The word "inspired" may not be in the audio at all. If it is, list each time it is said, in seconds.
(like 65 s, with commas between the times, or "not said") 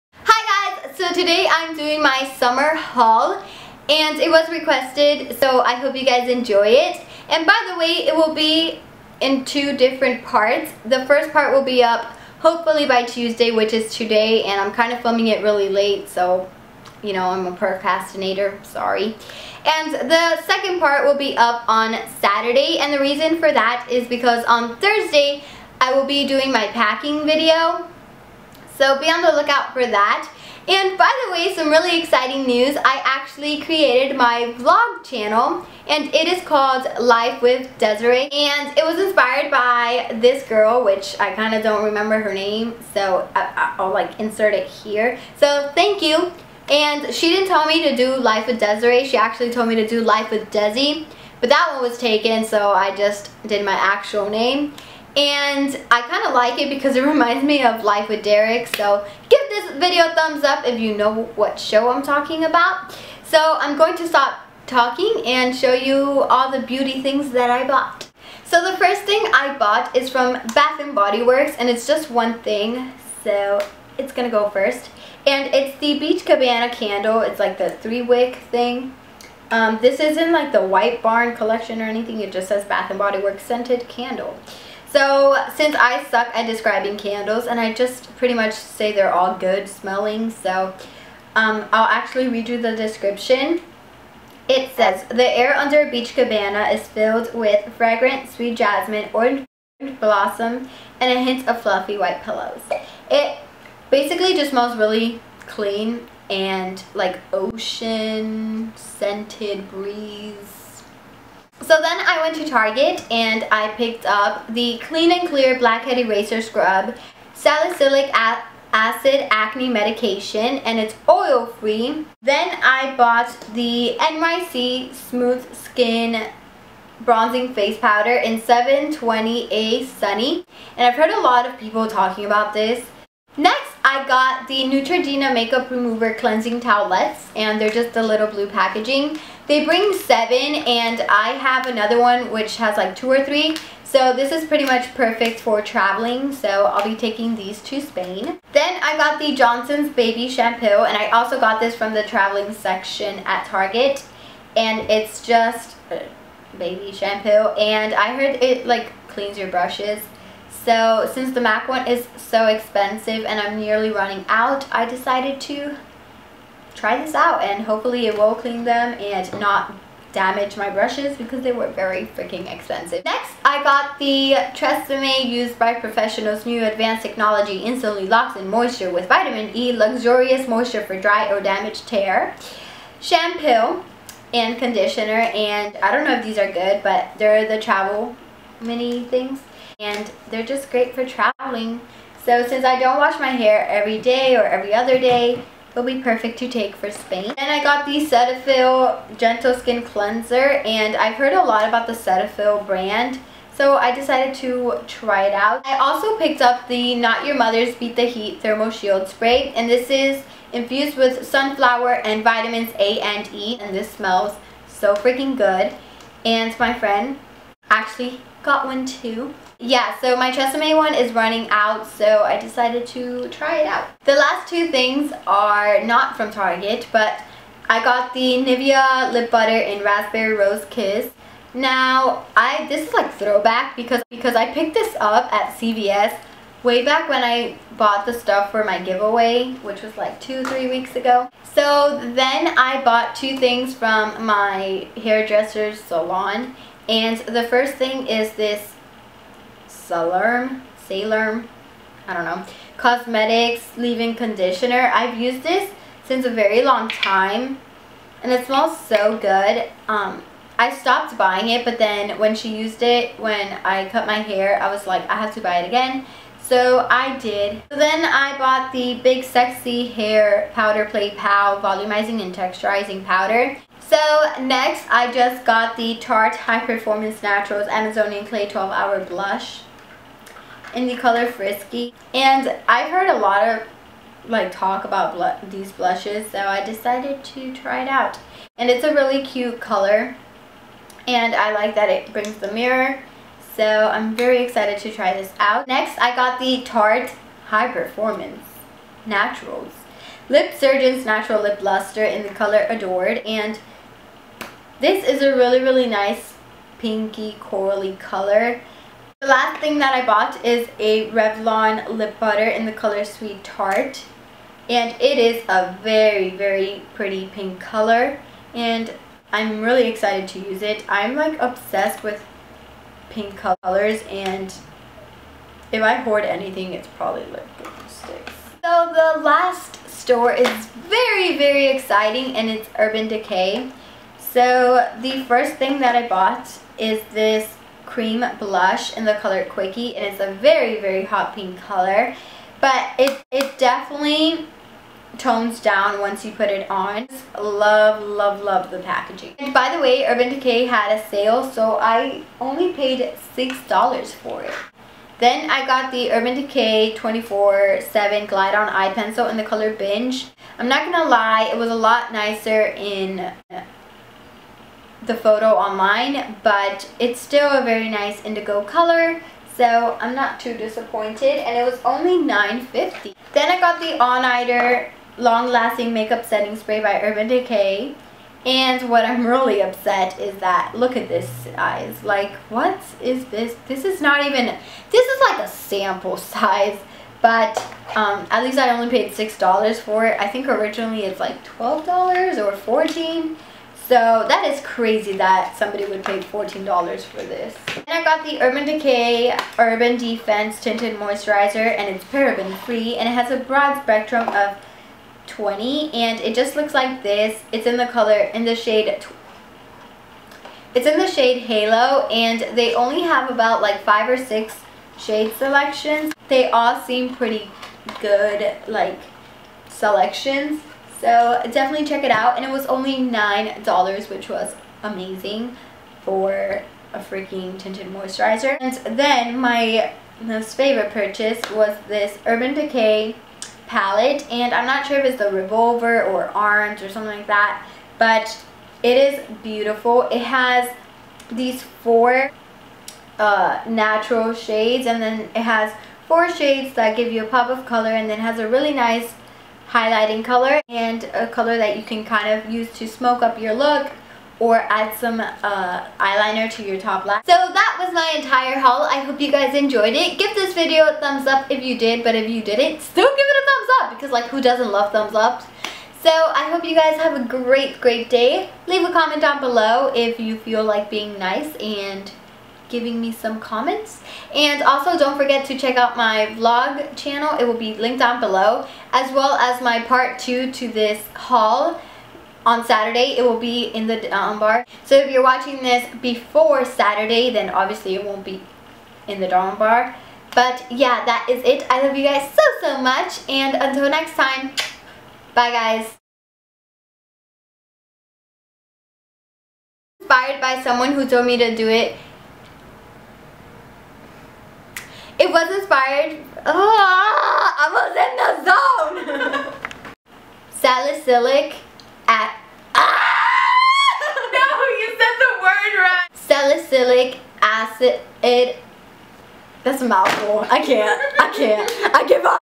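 38 s, 499 s, 505 s.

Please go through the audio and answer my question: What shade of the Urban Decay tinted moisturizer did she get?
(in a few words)
Halo.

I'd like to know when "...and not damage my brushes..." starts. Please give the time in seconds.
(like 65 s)
168 s.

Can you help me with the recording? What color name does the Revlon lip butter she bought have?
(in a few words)
Sweet Tart.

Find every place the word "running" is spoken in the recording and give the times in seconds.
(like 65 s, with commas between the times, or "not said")
163 s, 221 s.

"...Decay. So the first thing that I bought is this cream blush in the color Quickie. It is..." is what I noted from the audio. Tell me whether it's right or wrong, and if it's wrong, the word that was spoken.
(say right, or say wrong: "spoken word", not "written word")
right.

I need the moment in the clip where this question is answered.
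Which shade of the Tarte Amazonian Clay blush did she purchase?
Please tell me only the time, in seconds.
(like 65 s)
281 s.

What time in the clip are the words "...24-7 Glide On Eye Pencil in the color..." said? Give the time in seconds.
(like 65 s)
356 s.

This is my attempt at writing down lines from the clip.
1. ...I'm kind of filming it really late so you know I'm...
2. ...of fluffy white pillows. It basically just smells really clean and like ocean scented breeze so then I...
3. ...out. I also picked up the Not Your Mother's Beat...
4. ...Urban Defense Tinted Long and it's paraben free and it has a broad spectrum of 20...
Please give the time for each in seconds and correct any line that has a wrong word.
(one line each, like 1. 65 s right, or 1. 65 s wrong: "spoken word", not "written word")
1. 14 s right
2. 101 s right
3. 205 s right
4. 399 s wrong: "Moisturizer", not "Long".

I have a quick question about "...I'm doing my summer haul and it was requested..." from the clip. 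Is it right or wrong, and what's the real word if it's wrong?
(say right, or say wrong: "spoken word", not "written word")
right.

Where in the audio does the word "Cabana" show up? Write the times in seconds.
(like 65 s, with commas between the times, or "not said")
76 s, 96 s.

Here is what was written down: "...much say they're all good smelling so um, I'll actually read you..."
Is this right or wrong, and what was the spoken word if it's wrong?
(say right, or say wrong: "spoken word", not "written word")
right.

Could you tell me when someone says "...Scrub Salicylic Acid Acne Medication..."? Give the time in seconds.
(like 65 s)
116 s.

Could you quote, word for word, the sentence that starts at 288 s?
And it's a really cute color and I like that it brings the mirror so I'm very excited to try this out.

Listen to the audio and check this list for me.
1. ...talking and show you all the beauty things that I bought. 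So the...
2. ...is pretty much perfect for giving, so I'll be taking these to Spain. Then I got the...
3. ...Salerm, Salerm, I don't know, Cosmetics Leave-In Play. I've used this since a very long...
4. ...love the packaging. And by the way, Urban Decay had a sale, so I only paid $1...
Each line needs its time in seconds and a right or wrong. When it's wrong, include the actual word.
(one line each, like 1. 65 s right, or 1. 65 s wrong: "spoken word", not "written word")
1. 64 s right
2. 144 s wrong: "traveling", not "giving"
3. 249 s wrong: "Conditioner", not "Play"
4. 348 s wrong: "6", not "1".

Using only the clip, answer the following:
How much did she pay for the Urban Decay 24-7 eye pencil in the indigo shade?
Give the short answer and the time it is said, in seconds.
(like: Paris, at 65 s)
$9.50, at 372 s.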